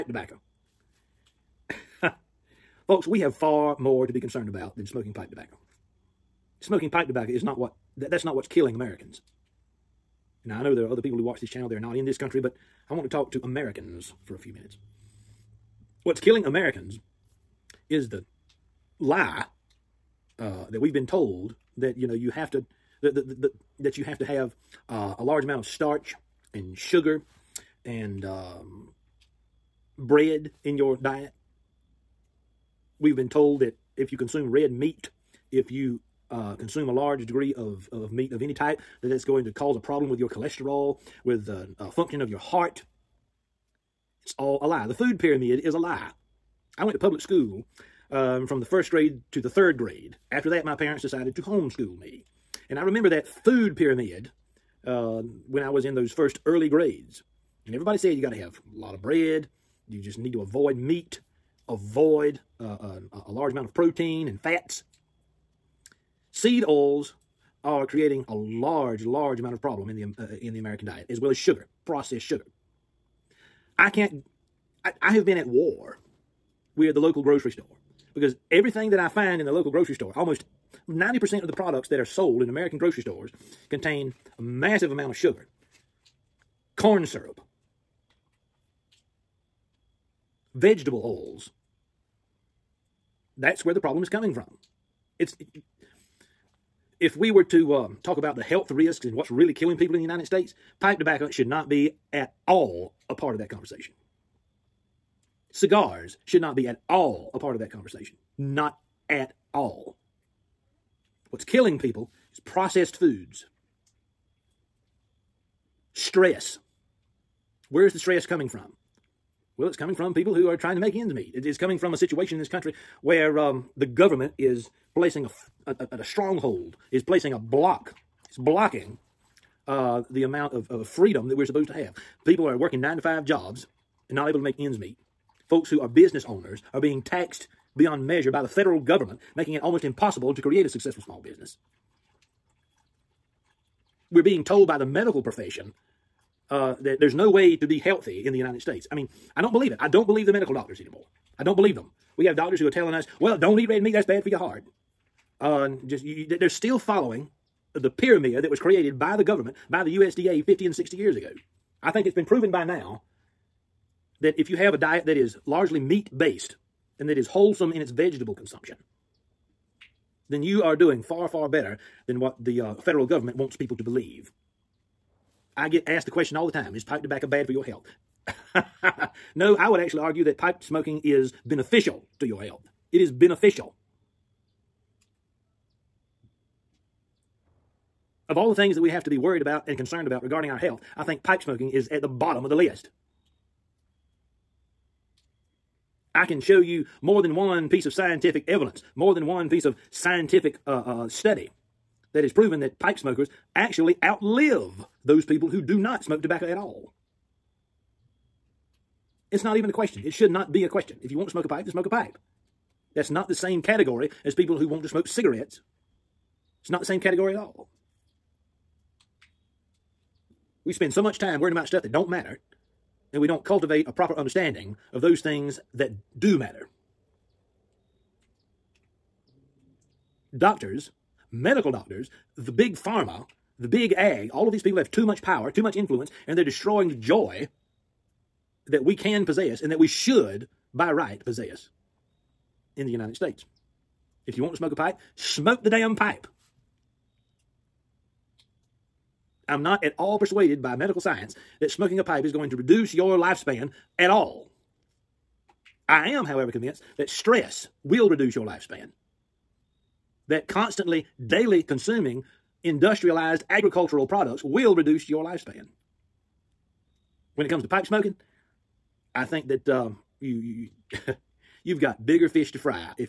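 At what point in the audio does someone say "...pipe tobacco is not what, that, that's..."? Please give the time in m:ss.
0:06.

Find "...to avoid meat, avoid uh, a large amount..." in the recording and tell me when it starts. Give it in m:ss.
1:00.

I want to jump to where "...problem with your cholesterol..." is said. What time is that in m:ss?
0:39.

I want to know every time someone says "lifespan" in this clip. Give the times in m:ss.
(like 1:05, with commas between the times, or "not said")
4:13, 4:18, 4:25.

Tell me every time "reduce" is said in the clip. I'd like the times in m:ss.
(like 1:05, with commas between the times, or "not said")
4:12, 4:18, 4:24.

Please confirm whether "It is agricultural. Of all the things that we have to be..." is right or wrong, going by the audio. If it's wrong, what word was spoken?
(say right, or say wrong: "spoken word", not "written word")
wrong: "beneficial", not "agricultural".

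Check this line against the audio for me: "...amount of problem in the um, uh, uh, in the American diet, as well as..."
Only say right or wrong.
right.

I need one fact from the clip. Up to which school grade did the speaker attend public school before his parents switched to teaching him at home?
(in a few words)
third grade.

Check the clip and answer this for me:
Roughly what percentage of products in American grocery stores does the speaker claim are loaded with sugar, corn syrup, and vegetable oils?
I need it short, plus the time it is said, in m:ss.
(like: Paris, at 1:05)
90%, at 1:20.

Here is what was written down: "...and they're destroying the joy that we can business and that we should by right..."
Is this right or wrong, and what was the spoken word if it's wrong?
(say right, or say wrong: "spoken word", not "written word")
wrong: "possess", not "business".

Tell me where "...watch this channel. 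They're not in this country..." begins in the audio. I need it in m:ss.
0:11.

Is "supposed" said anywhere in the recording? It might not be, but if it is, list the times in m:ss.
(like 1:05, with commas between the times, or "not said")
2:11.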